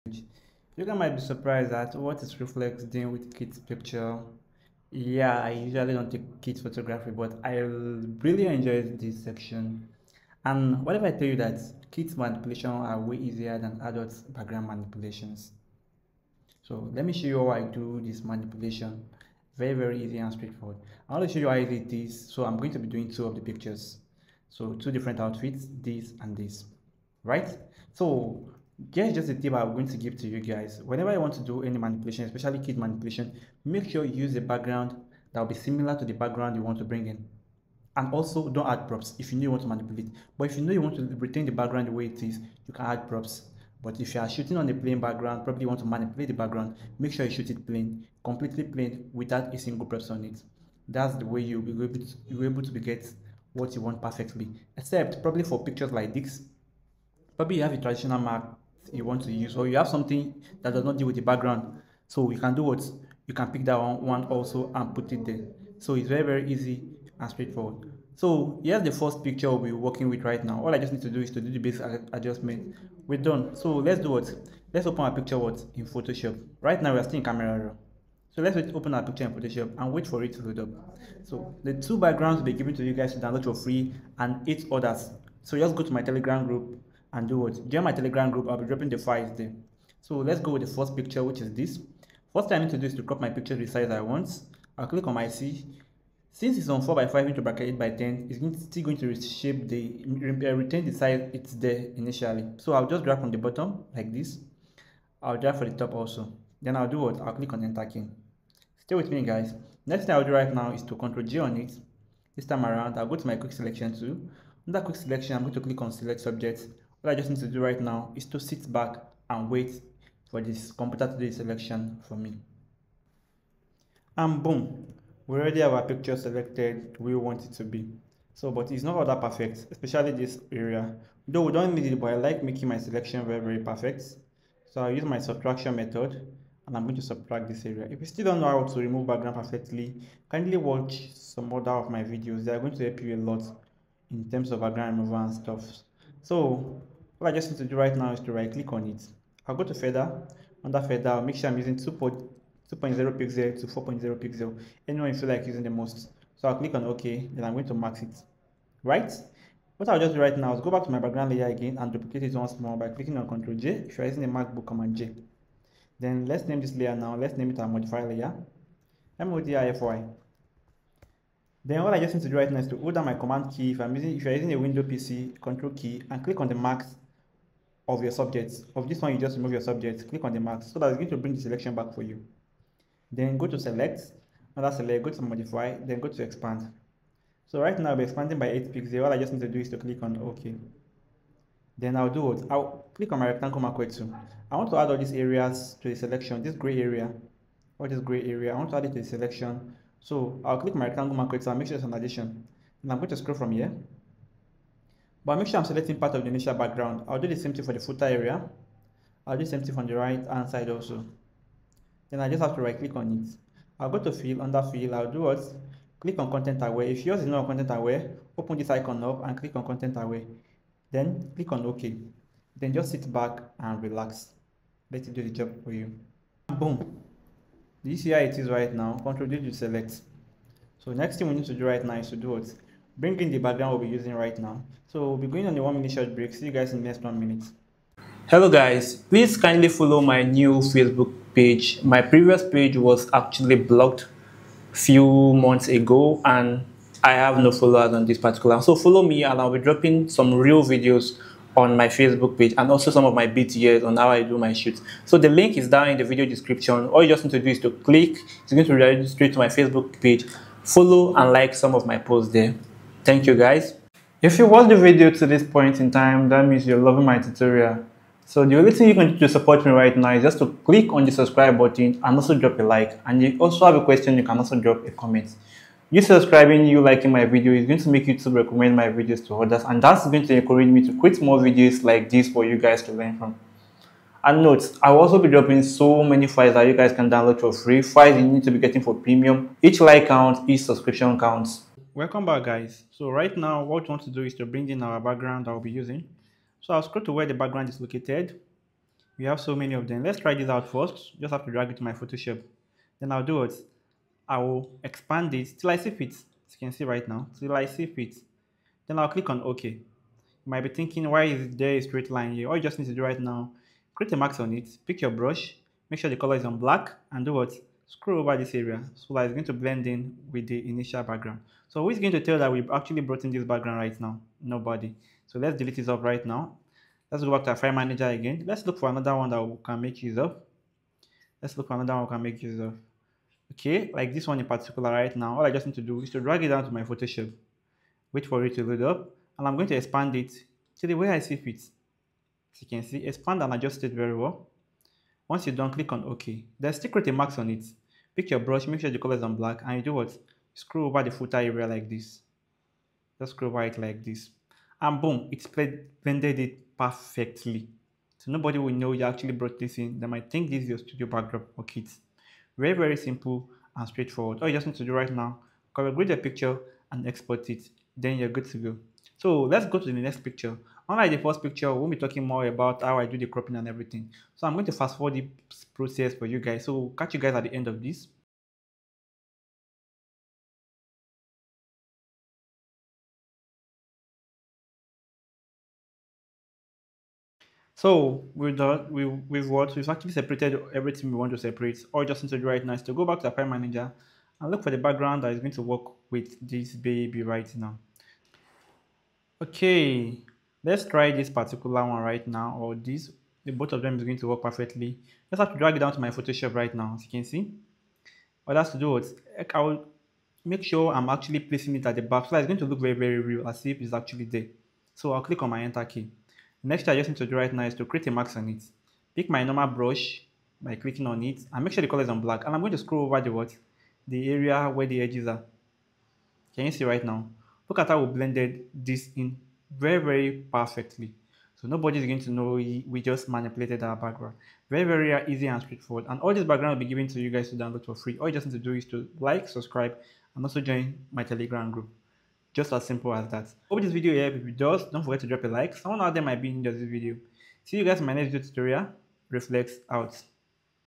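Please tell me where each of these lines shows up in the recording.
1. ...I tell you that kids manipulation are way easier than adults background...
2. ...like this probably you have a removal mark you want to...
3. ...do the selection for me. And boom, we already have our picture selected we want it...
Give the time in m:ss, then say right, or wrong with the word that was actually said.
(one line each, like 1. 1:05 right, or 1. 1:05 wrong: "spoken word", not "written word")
1. 0:11 right
2. 0:55 wrong: "traditional", not "removal"
3. 2:01 right.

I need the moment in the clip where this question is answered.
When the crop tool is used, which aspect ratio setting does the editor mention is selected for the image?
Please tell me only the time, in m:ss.
1:36.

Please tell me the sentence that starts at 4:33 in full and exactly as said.
And you also have a question, you can also drop a comment.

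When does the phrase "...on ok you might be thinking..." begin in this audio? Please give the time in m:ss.
5:09.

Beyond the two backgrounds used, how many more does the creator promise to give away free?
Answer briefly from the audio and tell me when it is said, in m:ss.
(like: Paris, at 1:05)
8, at 1:24.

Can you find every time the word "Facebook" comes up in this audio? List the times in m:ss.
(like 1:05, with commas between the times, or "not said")
4:00, 4:11, 4:19.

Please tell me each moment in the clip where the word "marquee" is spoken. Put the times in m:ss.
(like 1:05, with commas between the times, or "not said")
3:13, 3:21.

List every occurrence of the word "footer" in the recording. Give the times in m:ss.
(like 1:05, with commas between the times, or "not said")
3:27, 5:51.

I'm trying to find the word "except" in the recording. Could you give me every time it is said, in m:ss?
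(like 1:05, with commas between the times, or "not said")
0:54.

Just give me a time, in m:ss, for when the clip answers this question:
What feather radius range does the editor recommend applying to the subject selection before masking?
2:31.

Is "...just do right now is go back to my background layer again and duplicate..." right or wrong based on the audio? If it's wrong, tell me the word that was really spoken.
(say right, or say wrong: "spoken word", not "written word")
right.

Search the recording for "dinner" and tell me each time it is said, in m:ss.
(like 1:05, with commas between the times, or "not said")
not said.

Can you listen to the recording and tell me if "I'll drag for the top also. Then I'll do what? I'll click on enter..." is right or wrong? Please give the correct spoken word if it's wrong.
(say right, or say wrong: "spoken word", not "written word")
right.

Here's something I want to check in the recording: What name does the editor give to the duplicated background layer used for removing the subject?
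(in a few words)
modifier layer.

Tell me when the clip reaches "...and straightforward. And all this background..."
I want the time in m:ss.
7:15.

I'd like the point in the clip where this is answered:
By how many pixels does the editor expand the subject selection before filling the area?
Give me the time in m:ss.
3:08.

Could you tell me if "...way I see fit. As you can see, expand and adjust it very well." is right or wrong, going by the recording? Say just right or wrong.
right.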